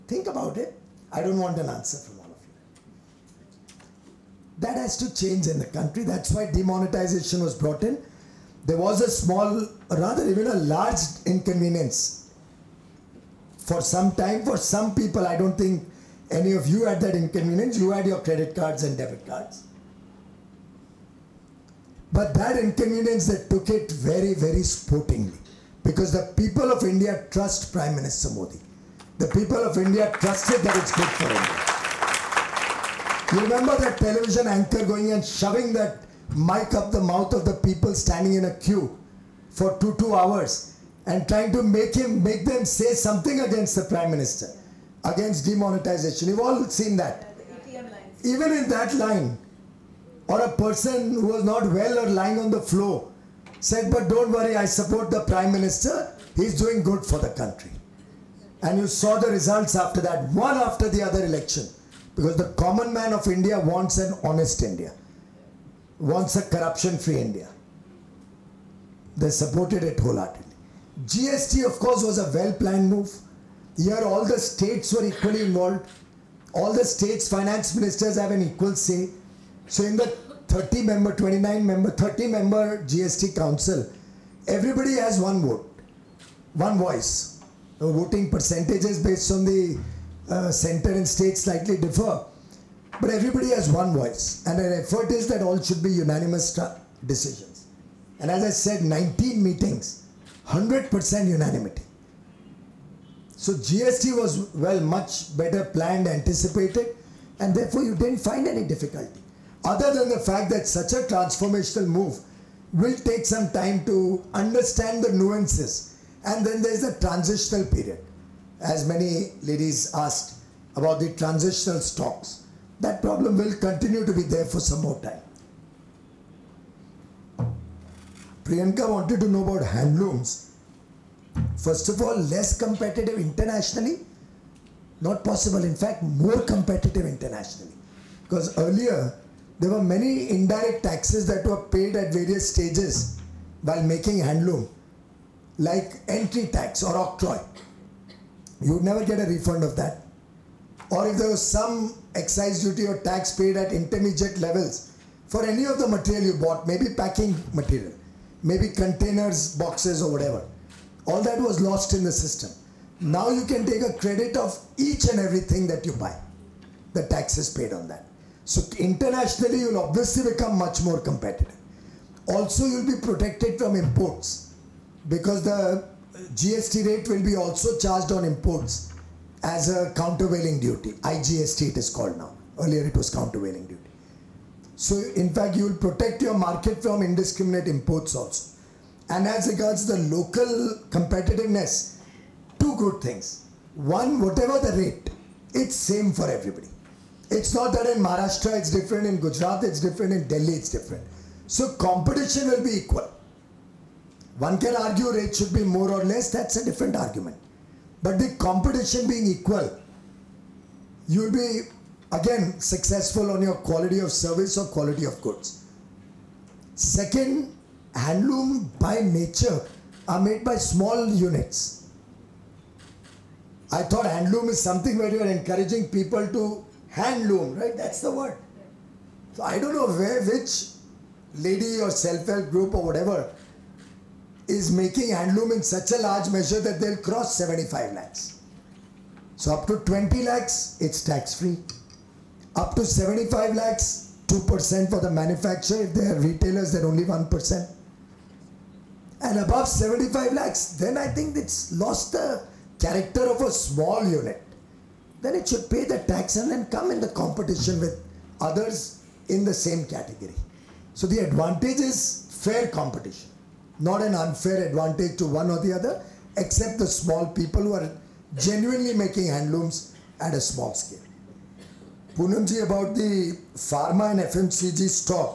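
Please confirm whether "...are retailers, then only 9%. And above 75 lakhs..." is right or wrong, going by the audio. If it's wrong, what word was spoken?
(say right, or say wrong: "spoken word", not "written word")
wrong: "1", not "9".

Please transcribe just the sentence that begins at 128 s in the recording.
Priyanka wanted to know about handlooms.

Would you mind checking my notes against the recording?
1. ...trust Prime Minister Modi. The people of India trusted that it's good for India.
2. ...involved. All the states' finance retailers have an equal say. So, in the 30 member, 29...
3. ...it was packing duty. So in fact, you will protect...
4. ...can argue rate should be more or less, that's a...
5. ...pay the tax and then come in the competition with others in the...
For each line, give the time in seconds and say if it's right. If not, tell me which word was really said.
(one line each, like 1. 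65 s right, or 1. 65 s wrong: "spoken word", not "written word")
1. 27 s right
2. 75 s wrong: "ministers", not "retailers"
3. 182 s wrong: "countervailing", not "packing"
4. 204 s right
5. 255 s right.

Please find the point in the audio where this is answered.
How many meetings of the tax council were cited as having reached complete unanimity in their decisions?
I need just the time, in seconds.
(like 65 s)
98 s.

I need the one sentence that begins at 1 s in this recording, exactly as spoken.
I don't want an answer from all of you.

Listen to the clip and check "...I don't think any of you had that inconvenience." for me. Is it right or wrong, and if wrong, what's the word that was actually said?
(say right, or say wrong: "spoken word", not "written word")
right.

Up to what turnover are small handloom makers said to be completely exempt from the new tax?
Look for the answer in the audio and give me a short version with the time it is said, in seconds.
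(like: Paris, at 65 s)
20 lakhs, at 239 s.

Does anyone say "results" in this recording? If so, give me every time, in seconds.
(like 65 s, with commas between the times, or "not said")
59 s.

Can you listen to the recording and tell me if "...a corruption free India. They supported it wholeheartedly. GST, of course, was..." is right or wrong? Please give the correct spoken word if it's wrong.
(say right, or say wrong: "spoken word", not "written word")
right.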